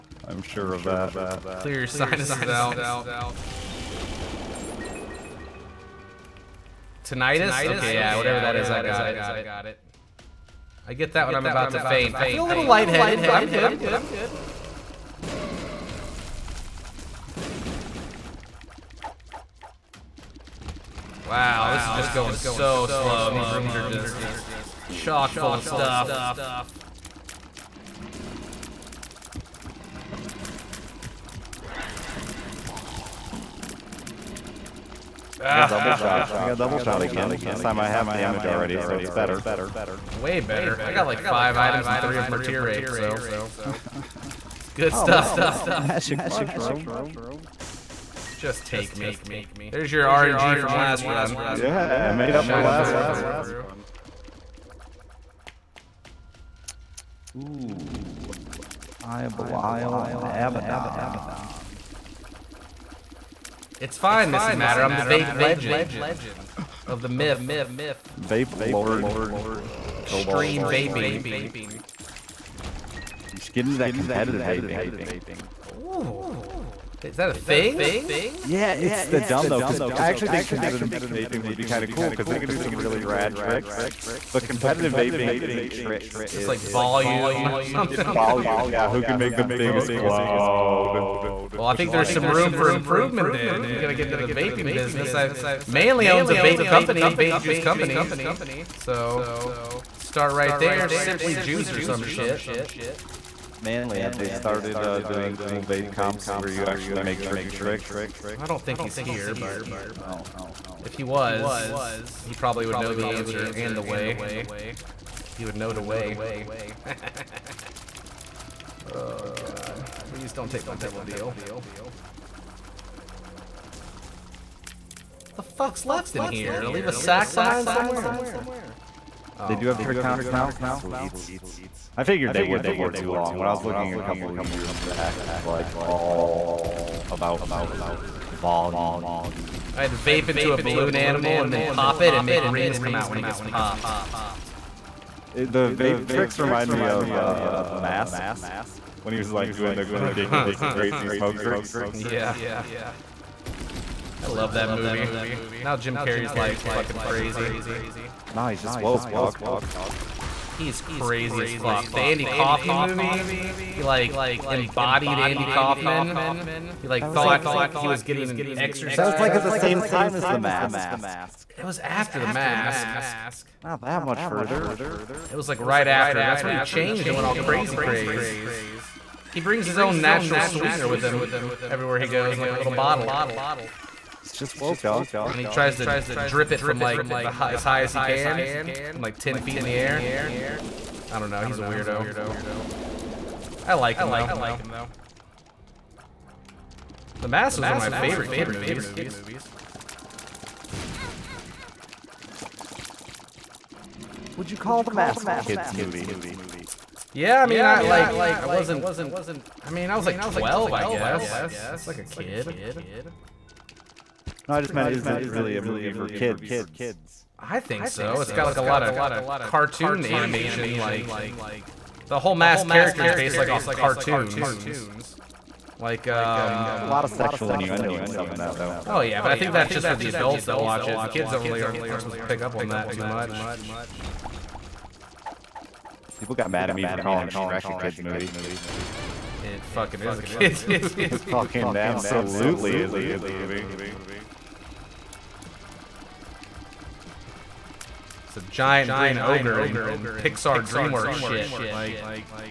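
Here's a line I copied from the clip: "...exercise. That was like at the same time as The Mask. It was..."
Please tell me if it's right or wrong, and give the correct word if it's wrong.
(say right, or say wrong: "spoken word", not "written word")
right.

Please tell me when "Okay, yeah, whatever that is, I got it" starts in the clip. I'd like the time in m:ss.
0:07.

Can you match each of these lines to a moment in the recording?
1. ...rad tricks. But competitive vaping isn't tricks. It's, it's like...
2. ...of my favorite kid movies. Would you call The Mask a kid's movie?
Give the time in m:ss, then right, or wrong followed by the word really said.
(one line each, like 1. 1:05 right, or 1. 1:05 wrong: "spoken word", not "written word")
1. 1:23 right
2. 3:17 right.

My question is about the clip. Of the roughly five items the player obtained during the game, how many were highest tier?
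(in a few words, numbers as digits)
3.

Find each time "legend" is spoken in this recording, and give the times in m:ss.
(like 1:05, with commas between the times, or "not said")
1:05.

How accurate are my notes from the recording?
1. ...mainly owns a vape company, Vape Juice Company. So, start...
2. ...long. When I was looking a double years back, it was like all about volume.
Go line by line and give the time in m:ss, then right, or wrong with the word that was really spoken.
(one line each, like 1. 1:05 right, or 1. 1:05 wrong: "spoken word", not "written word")
1. 1:35 right
2. 2:13 wrong: "couple", not "double".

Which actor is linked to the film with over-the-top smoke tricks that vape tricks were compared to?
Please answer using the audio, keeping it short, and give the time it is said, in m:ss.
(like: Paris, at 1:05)
Jim Carrey, at 2:35.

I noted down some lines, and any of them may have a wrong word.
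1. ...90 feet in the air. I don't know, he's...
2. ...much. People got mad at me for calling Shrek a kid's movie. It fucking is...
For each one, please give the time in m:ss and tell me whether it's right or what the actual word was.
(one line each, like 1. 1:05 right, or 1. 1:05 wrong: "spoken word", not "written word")
1. 3:09 wrong: "10", not "90"
2. 3:53 right.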